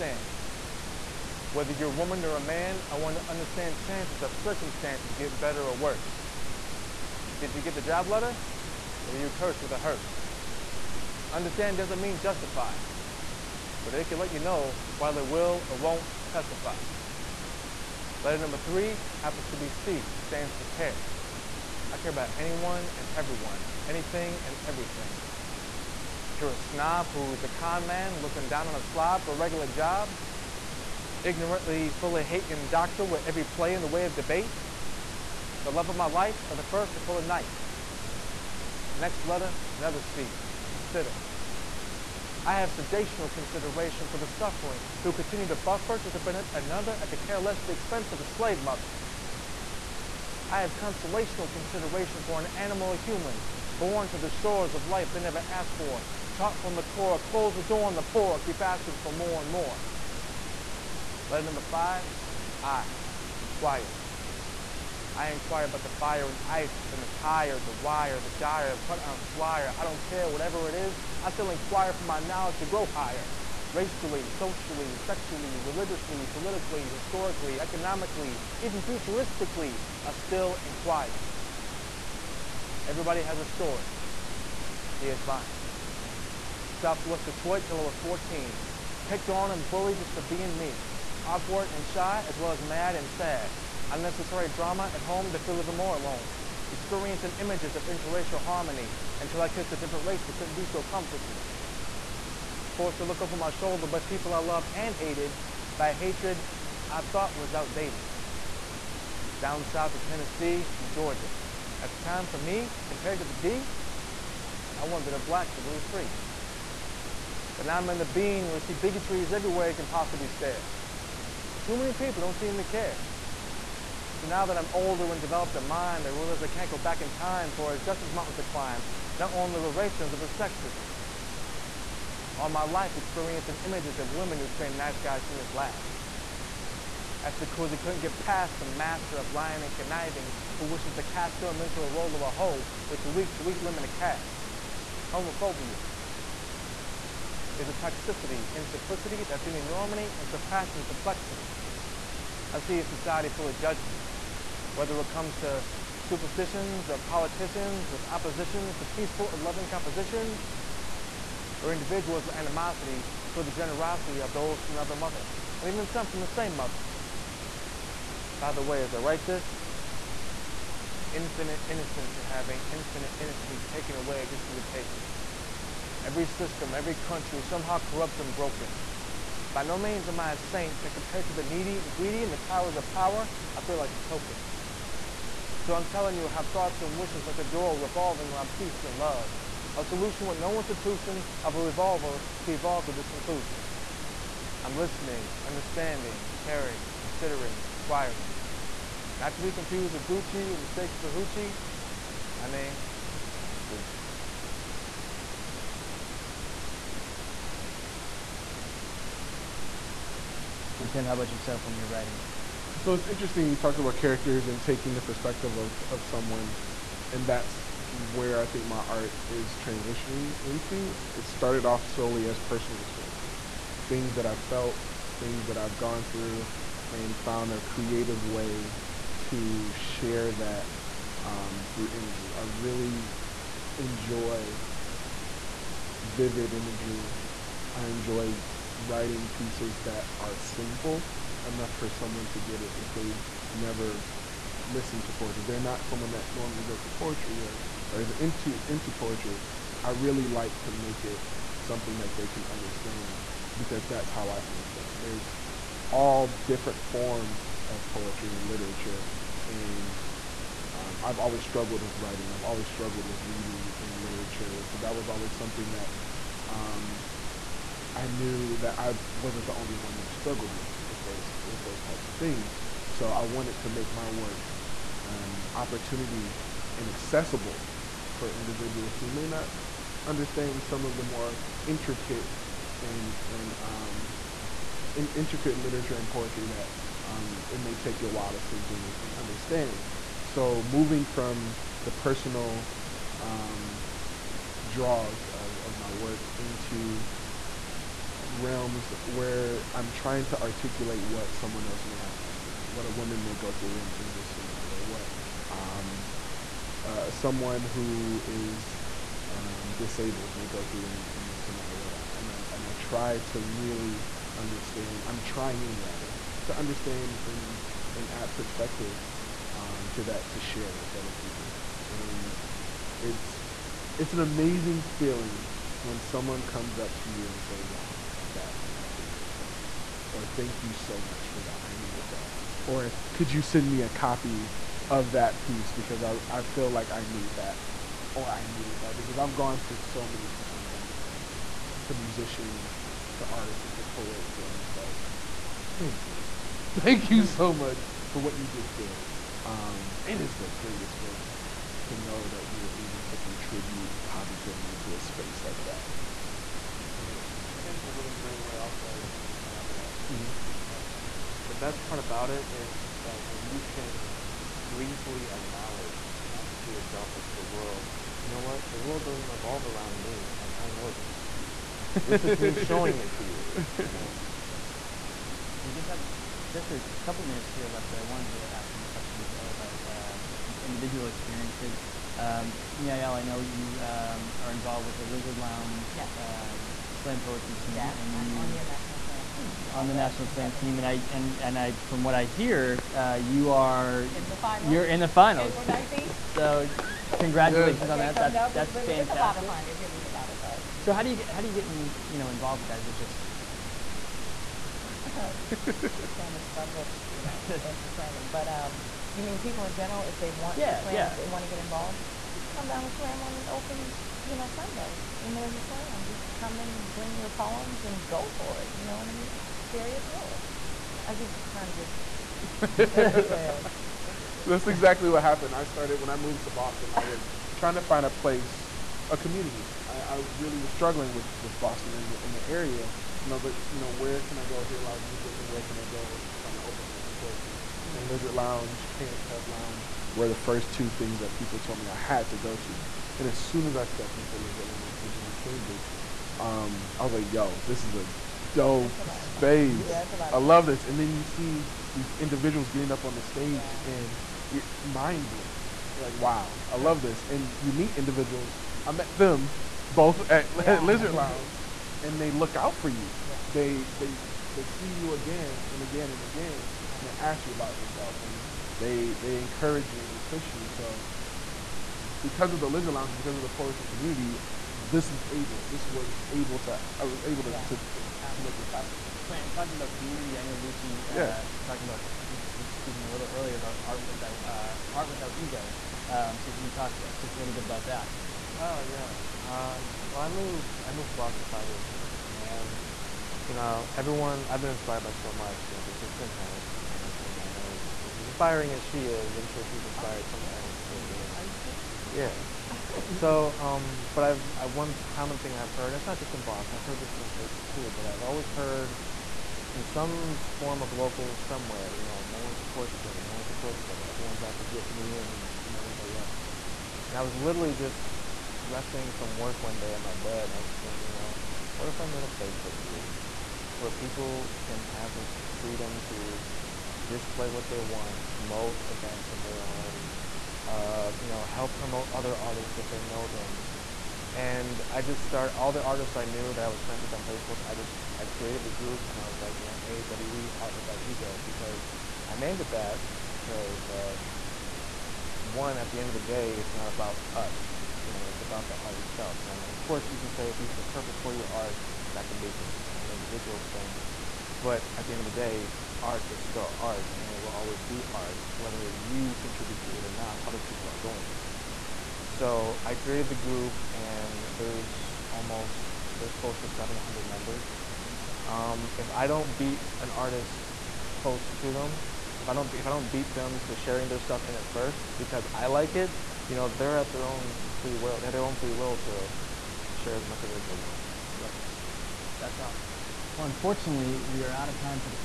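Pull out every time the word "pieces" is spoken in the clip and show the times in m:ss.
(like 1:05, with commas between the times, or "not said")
3:59, 5:35.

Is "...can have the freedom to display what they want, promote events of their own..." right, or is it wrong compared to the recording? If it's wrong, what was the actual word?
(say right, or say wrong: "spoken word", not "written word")
right.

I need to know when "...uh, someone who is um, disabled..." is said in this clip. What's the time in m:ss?
5:06.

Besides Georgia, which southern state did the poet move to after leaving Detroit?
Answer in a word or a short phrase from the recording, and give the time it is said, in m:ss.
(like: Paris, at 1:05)
Tennessee, at 1:49.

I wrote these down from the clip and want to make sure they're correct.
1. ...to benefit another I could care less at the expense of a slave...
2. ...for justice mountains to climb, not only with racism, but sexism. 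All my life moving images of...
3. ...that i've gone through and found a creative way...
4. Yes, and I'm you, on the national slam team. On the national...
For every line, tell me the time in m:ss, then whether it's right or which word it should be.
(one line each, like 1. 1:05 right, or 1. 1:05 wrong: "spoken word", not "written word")
1. 0:46 right
2. 2:07 wrong: "experiencing", not "moving"
3. 3:45 right
4. 6:27 right.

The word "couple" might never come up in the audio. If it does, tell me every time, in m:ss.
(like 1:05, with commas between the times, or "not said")
6:17.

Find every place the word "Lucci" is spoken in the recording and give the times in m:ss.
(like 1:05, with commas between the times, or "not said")
3:23, 8:00.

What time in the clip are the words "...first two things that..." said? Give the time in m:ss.
7:20.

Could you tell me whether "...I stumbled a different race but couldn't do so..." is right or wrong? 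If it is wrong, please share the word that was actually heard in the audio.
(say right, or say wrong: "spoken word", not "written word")
wrong: "kissed", not "stumbled".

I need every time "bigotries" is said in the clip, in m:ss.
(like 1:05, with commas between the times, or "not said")
1:58.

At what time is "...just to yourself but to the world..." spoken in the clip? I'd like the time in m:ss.
6:06.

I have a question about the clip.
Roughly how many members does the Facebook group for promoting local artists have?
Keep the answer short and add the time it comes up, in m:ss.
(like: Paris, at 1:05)
700, at 9:26.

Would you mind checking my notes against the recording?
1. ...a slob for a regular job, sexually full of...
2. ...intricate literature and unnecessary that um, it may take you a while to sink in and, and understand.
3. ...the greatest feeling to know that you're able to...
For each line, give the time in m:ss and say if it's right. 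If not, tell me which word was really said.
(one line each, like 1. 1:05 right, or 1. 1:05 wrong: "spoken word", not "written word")
1. 0:28 wrong: "ignorantly", not "sexually"
2. 4:45 wrong: "poetry", not "unnecessary"
3. 5:50 right.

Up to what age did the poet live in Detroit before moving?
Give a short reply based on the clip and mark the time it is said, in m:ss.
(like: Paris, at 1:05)
14, at 1:27.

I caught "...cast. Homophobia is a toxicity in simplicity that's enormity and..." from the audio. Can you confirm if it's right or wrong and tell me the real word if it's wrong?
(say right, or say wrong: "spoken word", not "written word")
right.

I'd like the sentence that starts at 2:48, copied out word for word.
By the way, as I write this, infinite innocence are having infinite innocence taken away just for the taking.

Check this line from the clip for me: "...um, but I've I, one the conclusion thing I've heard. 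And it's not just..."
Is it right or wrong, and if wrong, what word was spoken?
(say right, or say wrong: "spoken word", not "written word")
wrong: "common", not "conclusion".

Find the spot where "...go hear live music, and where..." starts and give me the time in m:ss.
7:14.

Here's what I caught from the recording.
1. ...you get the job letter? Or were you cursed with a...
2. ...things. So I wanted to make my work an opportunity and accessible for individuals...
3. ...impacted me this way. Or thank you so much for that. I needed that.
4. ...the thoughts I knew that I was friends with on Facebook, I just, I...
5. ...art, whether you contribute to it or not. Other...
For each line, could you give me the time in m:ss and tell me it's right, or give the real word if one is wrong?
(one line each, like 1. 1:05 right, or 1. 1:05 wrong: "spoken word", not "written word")
1. 0:07 right
2. 4:32 right
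3. 5:28 right
4. 8:55 wrong: "artists", not "thoughts"
5. 9:18 right.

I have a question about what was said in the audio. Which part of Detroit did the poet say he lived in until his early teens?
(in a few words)
Southwest Detroit.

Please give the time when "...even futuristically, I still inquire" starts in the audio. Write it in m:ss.
1:18.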